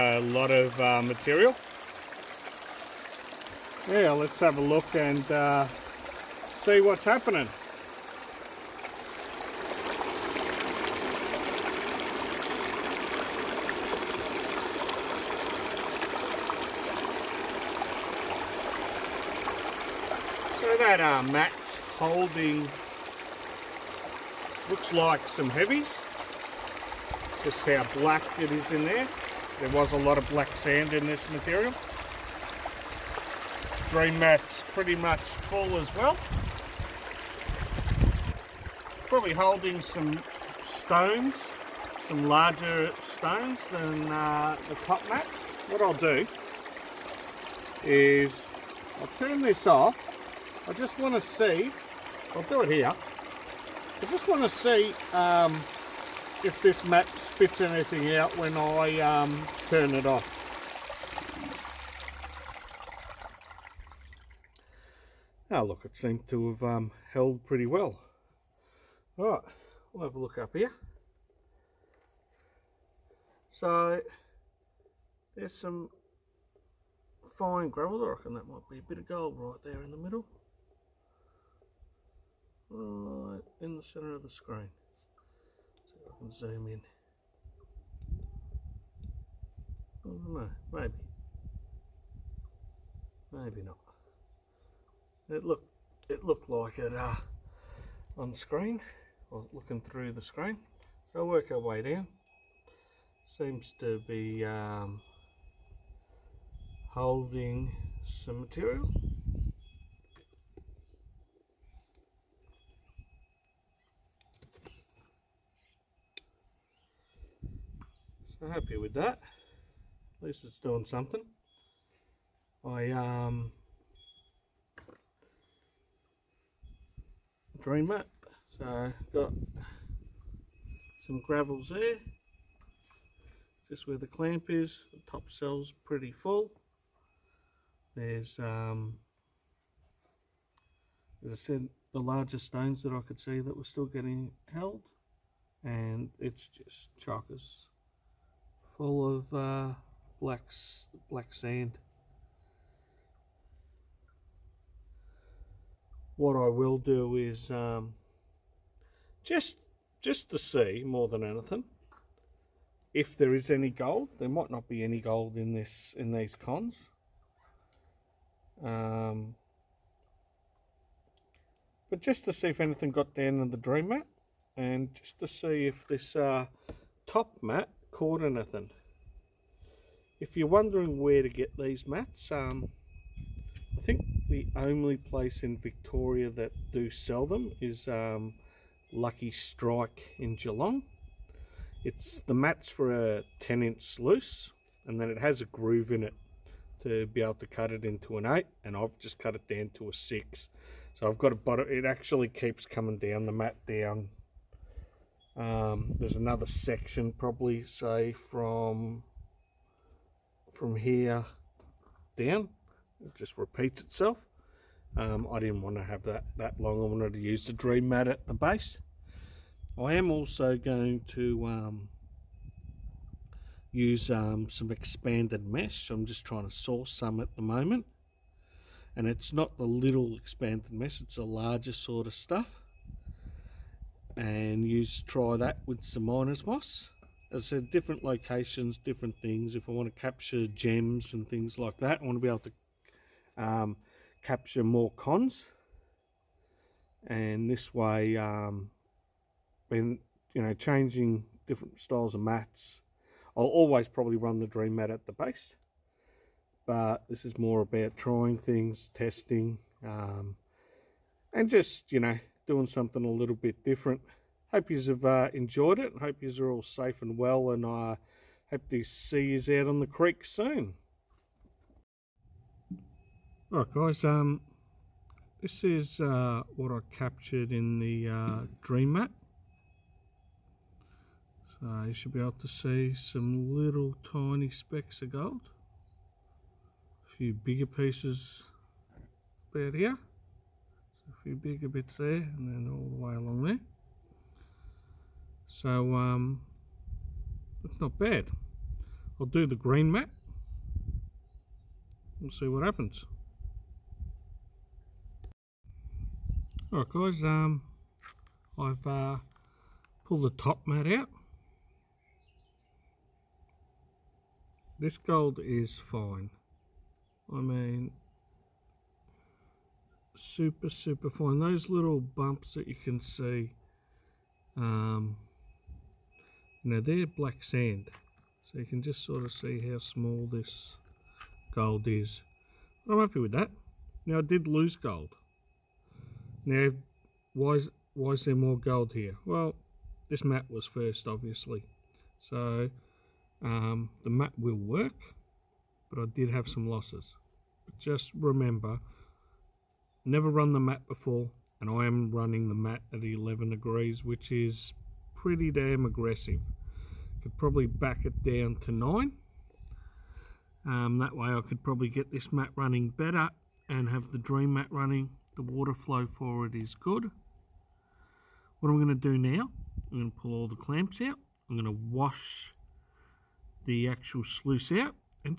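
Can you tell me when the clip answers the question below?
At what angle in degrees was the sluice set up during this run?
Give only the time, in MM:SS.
05:53.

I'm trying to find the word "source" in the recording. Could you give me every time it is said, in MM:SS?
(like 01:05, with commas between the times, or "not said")
03:46.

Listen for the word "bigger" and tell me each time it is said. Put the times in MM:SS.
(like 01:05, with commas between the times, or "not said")
04:47, 04:51.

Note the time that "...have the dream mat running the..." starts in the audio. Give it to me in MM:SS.
06:03.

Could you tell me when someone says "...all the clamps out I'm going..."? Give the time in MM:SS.
06:10.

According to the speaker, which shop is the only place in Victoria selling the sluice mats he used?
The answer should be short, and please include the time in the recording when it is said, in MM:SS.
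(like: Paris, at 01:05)
Lucky Strike, at 03:08.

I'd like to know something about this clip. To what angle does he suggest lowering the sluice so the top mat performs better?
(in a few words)
9.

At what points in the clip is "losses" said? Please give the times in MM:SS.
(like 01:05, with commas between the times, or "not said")
05:46.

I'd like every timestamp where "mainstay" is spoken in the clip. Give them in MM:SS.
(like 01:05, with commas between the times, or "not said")
not said.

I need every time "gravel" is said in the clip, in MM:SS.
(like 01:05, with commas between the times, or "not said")
01:17, 02:11.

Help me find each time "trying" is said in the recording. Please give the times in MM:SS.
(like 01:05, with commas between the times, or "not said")
03:46, 04:17.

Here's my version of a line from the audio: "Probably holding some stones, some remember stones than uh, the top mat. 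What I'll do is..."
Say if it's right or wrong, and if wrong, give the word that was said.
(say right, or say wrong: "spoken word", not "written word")
wrong: "larger", not "remember".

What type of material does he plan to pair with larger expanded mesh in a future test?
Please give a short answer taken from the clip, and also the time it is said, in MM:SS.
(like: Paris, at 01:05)
miners moss, at 03:56.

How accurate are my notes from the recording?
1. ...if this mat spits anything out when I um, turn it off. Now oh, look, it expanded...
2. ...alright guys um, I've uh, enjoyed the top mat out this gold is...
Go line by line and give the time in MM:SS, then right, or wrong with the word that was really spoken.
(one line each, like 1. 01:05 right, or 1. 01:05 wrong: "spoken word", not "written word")
1. 00:56 wrong: "seemed", not "expanded"
2. 05:06 wrong: "pulled", not "enjoyed".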